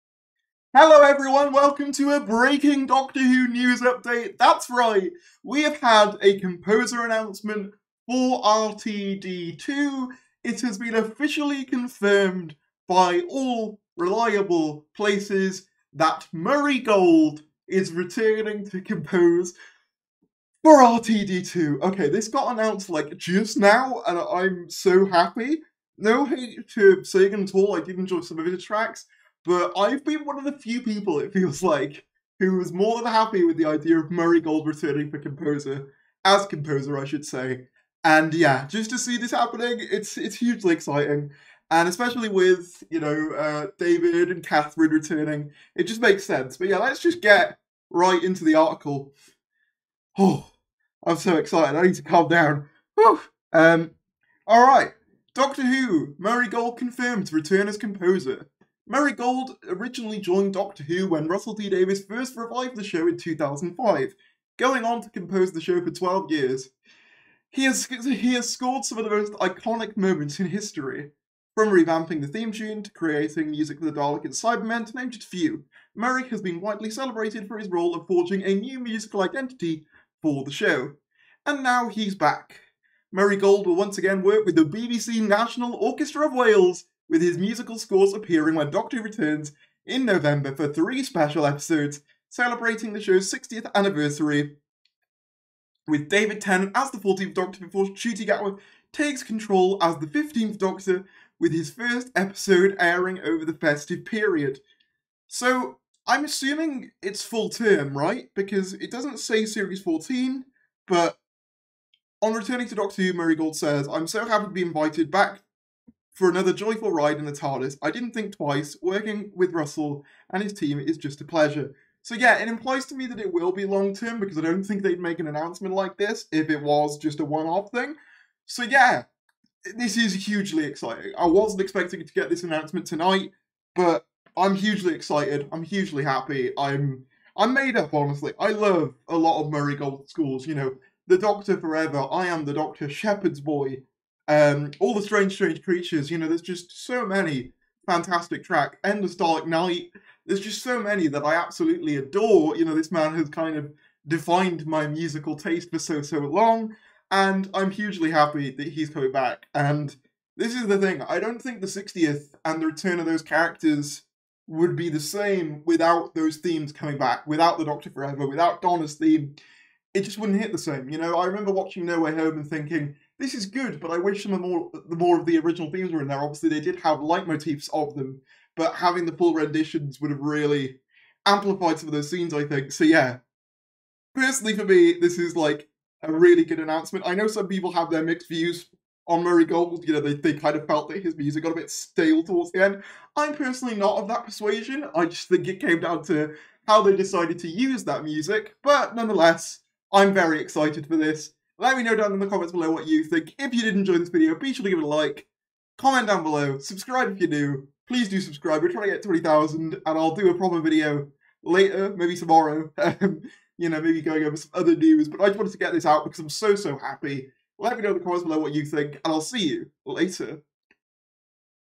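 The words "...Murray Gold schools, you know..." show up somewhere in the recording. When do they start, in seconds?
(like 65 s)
139 s.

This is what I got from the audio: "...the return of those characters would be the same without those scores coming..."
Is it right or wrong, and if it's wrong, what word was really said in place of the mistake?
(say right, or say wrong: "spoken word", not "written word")
wrong: "themes", not "scores".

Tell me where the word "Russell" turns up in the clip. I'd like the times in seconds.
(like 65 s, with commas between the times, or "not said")
61 s, 119 s.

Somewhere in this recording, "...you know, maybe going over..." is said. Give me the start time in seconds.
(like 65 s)
213 s.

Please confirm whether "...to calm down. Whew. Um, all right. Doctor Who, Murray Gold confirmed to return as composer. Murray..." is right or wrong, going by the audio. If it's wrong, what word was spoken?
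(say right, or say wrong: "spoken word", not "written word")
right.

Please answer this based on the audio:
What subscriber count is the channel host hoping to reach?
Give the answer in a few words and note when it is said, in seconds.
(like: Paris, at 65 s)
20,000, at 209 s.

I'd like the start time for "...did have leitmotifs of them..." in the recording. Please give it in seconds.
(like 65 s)
176 s.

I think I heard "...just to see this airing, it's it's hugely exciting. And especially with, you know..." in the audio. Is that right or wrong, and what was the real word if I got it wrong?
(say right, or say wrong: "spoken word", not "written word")
wrong: "happening", not "airing".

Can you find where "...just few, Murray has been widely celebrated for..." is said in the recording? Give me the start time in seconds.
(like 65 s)
75 s.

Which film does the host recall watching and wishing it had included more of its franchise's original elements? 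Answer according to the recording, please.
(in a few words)
No Way Home.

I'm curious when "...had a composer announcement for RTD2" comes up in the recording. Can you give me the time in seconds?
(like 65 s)
5 s.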